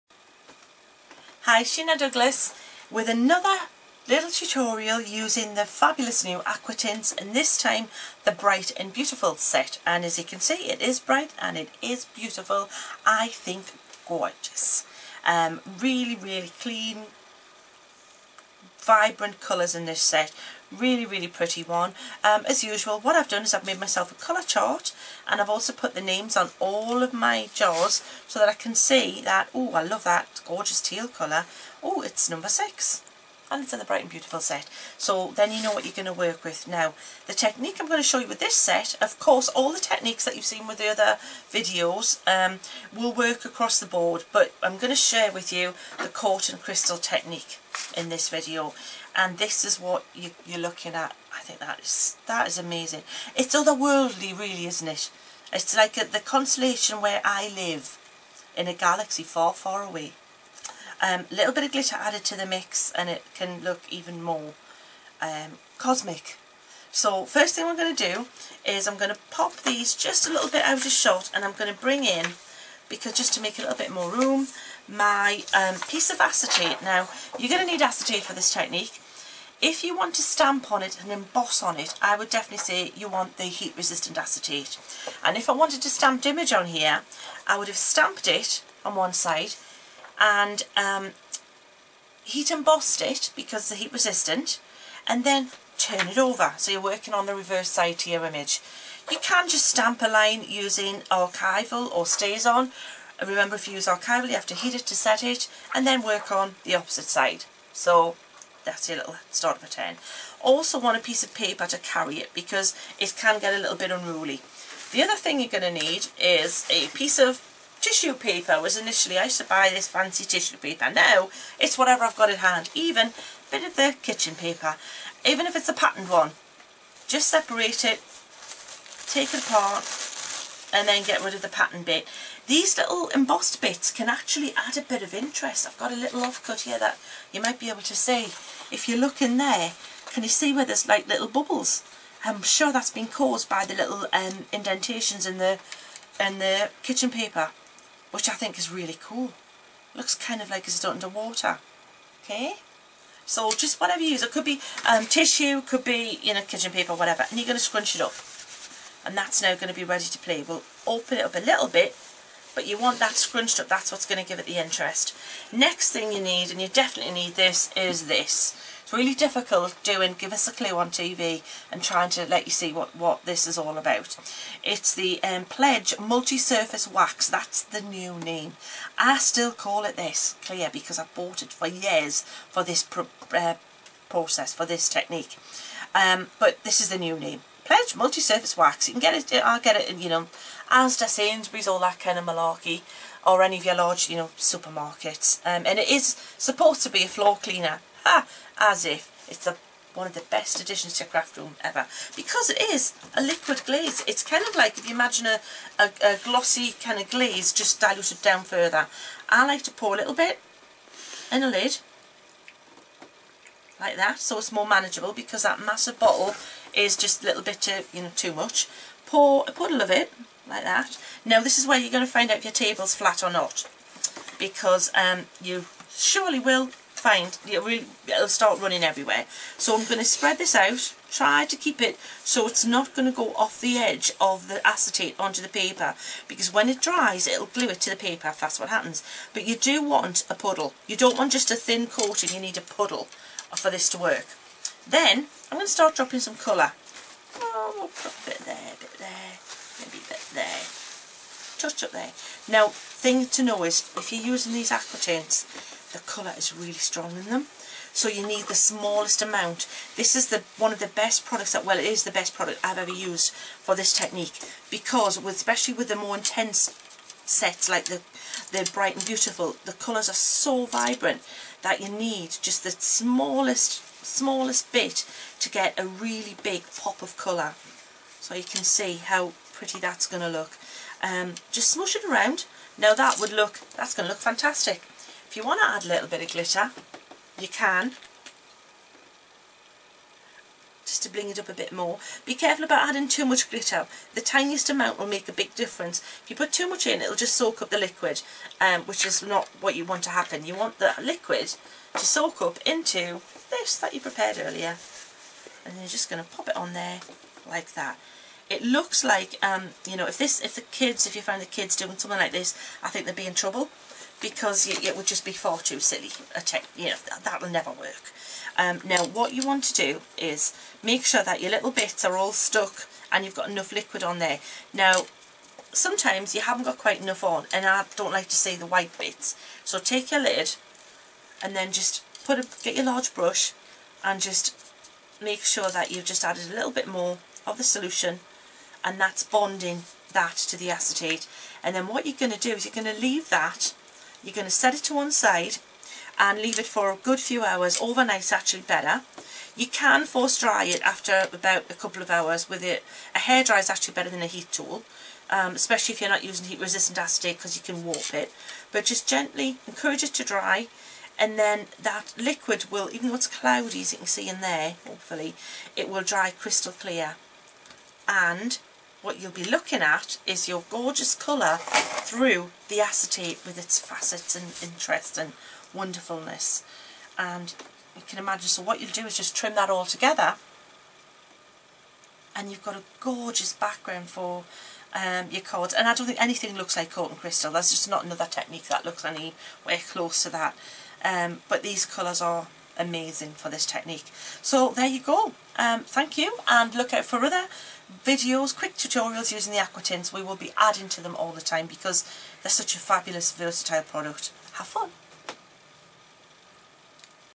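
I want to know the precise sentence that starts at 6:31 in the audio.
Um, but these colours are amazing for this technique.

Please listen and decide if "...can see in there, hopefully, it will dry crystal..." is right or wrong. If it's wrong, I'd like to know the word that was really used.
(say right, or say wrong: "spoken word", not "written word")
right.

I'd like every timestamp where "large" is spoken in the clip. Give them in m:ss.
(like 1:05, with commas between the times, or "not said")
3:13, 5:32.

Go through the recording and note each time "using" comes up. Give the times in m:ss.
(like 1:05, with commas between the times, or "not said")
0:05, 1:40, 4:14, 5:56, 6:39.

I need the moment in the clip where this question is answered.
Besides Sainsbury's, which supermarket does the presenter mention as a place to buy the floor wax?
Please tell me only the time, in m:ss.
3:10.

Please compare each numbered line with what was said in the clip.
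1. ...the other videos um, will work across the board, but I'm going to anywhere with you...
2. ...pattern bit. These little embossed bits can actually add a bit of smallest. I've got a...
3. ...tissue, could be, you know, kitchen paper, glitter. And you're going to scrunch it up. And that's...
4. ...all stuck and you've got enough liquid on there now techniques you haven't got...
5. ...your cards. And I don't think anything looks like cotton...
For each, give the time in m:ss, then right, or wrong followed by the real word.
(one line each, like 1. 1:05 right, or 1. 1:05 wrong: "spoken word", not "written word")
1. 0:40 wrong: "share", not "anywhere"
2. 2:11 wrong: "interest", not "smallest"
3. 2:35 wrong: "whatever", not "glitter"
4. 5:22 wrong: "sometimes", not "techniques"
5. 6:25 right.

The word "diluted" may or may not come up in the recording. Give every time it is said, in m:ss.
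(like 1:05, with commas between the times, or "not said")
3:27.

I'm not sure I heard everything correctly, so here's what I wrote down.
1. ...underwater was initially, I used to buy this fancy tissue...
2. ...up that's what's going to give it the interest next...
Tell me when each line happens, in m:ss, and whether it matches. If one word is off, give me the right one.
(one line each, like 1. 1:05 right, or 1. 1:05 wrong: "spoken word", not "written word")
1. 1:58 wrong: "paper", not "underwater"
2. 2:43 right.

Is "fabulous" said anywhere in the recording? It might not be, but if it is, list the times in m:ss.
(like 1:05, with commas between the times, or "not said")
0:05, 6:42.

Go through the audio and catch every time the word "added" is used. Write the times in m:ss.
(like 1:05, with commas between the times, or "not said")
1:01, 5:36.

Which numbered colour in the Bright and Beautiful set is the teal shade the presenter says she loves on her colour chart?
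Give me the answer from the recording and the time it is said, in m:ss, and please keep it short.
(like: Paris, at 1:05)
6, at 0:32.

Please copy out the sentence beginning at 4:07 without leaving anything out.
Oh, we'll a bit there, a bit there, maybe a bit there.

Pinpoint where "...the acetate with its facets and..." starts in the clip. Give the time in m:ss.
6:12.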